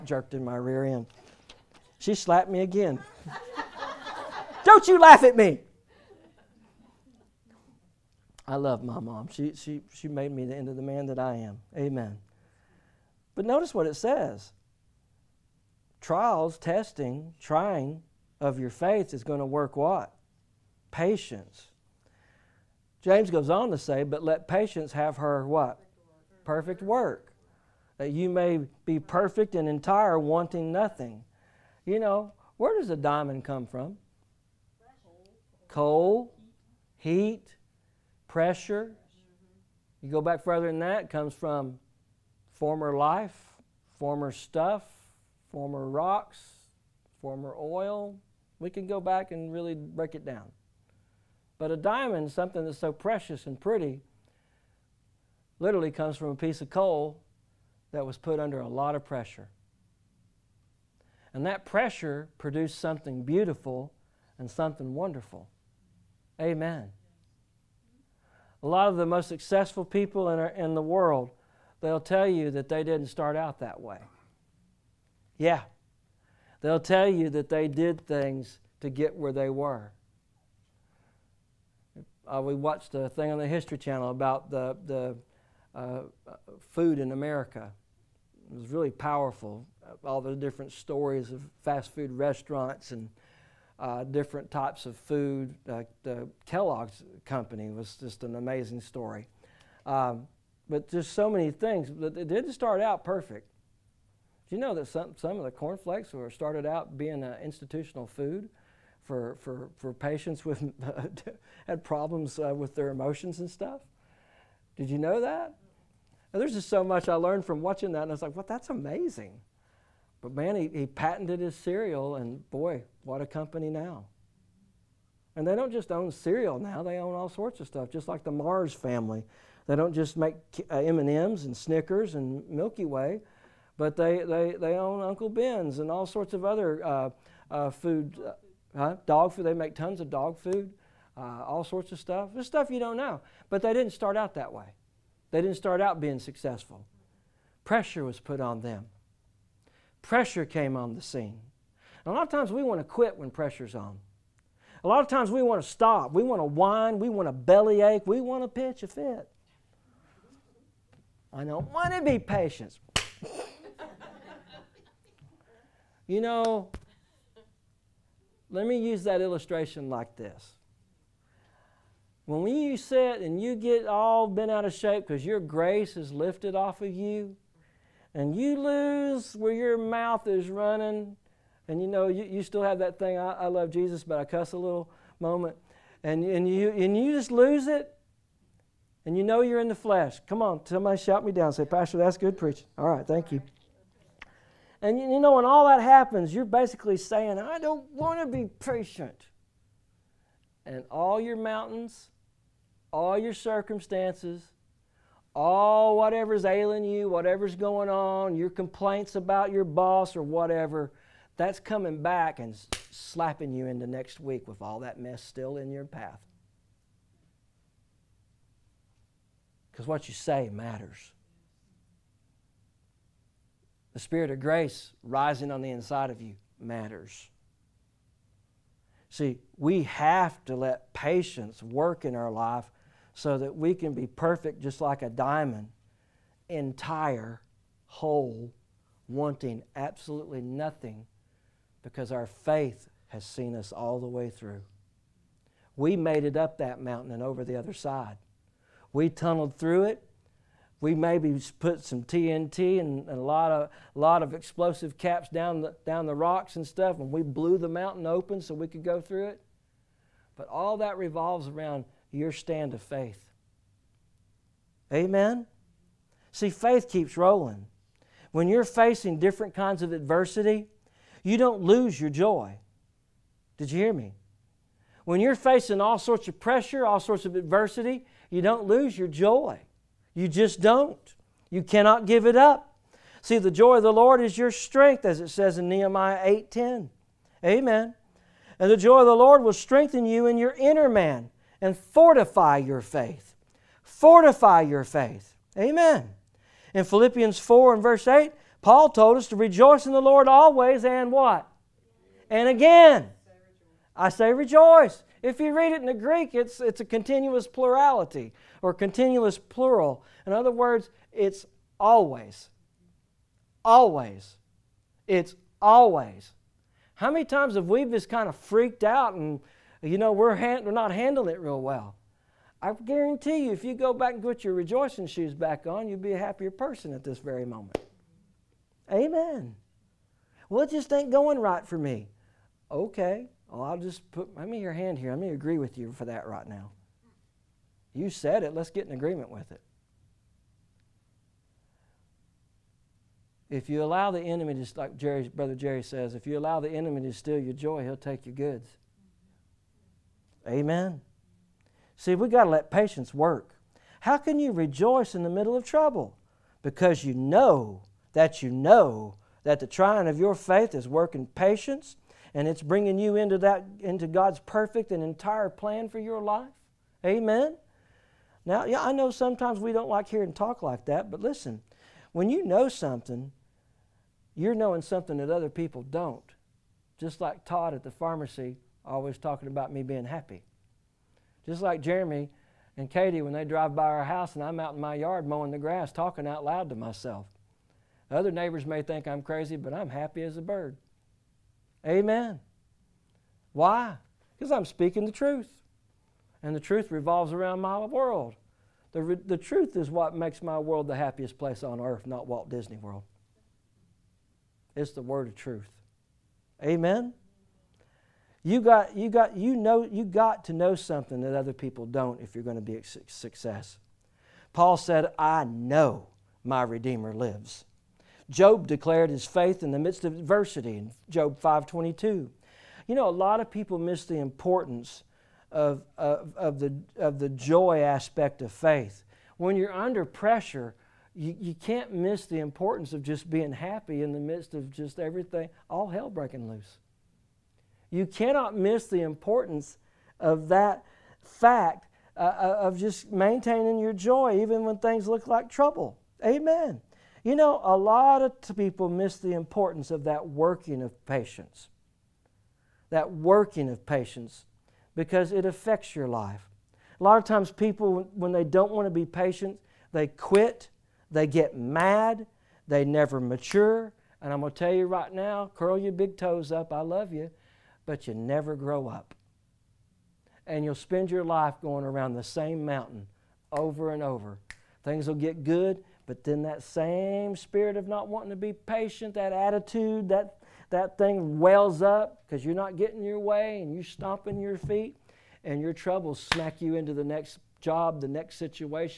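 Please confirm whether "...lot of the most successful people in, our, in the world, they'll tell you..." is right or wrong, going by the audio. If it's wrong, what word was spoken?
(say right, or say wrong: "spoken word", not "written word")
right.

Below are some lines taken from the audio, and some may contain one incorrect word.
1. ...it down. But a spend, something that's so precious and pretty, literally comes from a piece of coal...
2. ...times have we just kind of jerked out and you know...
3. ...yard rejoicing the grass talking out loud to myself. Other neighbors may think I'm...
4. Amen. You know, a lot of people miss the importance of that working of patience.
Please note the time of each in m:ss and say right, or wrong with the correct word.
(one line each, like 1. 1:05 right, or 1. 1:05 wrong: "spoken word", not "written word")
1. 0:50 wrong: "diamond", not "spend"
2. 5:17 wrong: "freaked", not "jerked"
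3. 6:24 wrong: "mowing", not "rejoicing"
4. 7:26 right.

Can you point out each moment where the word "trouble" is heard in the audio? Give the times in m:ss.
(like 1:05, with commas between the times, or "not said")
5:55, 7:25, 8:05.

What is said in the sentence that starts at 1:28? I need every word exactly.
It was really powerful all the different stories of fast food restaurants and uh, different types of food.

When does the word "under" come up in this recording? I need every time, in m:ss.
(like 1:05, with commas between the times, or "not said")
0:58, 7:09.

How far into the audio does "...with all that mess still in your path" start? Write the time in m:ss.
3:34.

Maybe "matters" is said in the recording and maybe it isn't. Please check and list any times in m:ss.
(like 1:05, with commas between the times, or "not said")
3:40, 3:46.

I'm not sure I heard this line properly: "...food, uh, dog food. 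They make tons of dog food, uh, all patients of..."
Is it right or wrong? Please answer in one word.
wrong.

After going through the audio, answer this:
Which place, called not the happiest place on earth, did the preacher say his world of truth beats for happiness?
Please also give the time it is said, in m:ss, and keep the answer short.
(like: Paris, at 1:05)
Walt Disney World, at 6:42.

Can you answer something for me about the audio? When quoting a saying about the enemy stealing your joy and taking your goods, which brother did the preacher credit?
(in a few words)
Brother Jerry.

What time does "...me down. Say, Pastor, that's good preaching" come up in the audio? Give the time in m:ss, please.
3:11.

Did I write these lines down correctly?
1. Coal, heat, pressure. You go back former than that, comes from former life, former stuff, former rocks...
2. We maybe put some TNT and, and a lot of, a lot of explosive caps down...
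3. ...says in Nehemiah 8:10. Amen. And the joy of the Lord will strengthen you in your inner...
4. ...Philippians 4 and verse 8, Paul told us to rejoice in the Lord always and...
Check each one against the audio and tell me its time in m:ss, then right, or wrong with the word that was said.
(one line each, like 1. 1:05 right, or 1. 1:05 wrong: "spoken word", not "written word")
1. 0:35 wrong: "further", not "former"
2. 4:10 right
3. 4:45 right
4. 4:56 right.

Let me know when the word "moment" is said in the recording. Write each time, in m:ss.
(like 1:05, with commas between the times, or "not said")
3:05, 5:27.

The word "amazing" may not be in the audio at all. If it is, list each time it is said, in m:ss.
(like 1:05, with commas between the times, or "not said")
1:38, 1:58.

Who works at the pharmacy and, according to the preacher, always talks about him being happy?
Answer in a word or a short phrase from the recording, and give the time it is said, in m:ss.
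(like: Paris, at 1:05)
Todd, at 6:17.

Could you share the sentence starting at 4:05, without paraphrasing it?
We made it up that mountain and over the other side.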